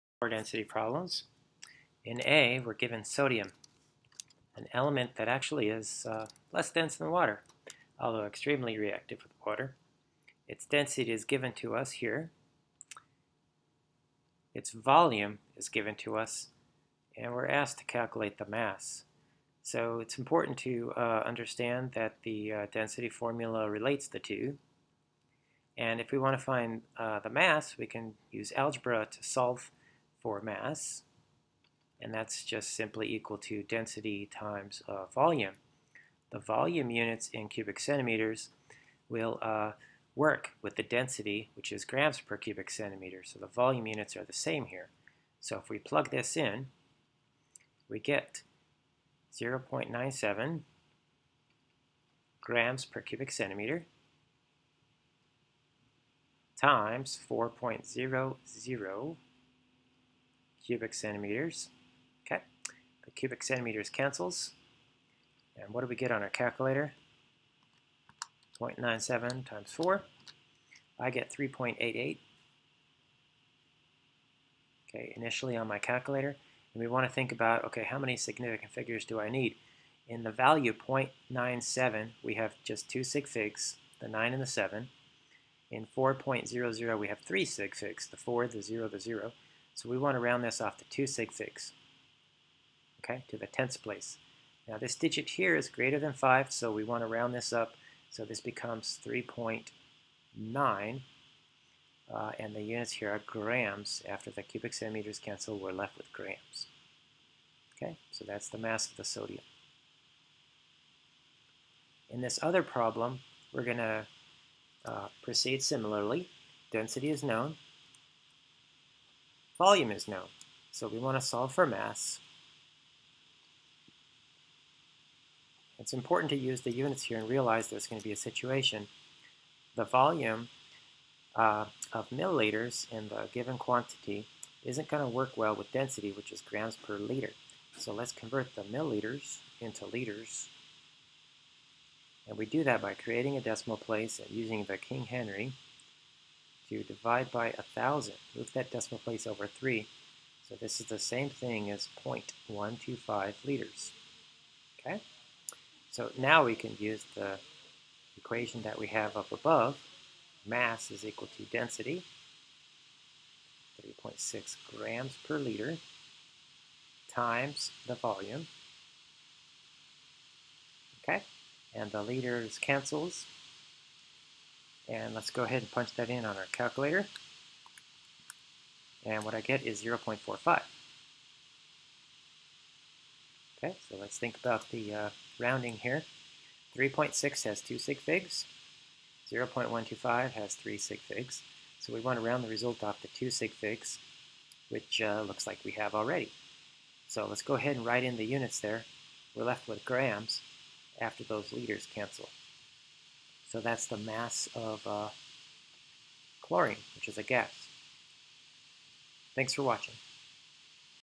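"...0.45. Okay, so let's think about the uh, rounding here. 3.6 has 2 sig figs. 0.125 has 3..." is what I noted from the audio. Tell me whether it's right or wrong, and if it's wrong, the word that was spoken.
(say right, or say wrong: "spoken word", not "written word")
right.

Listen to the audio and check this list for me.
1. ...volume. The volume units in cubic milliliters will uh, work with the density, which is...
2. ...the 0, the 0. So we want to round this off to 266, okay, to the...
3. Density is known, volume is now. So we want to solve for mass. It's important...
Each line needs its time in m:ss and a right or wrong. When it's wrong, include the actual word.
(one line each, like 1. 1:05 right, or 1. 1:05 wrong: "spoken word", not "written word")
1. 0:35 wrong: "centimeters", not "milliliters"
2. 1:28 right
3. 1:56 right.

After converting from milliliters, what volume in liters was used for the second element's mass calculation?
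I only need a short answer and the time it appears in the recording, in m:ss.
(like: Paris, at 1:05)
0.125 liters, at 2:32.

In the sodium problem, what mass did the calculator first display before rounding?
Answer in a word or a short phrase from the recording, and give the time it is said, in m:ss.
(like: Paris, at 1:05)
3.88, at 1:11.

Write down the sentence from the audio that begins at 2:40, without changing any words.
Mass is equal to density, 3.6 grams per liter, times the volume.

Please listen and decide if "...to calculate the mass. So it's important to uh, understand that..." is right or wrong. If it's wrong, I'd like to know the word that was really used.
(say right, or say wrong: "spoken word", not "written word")
right.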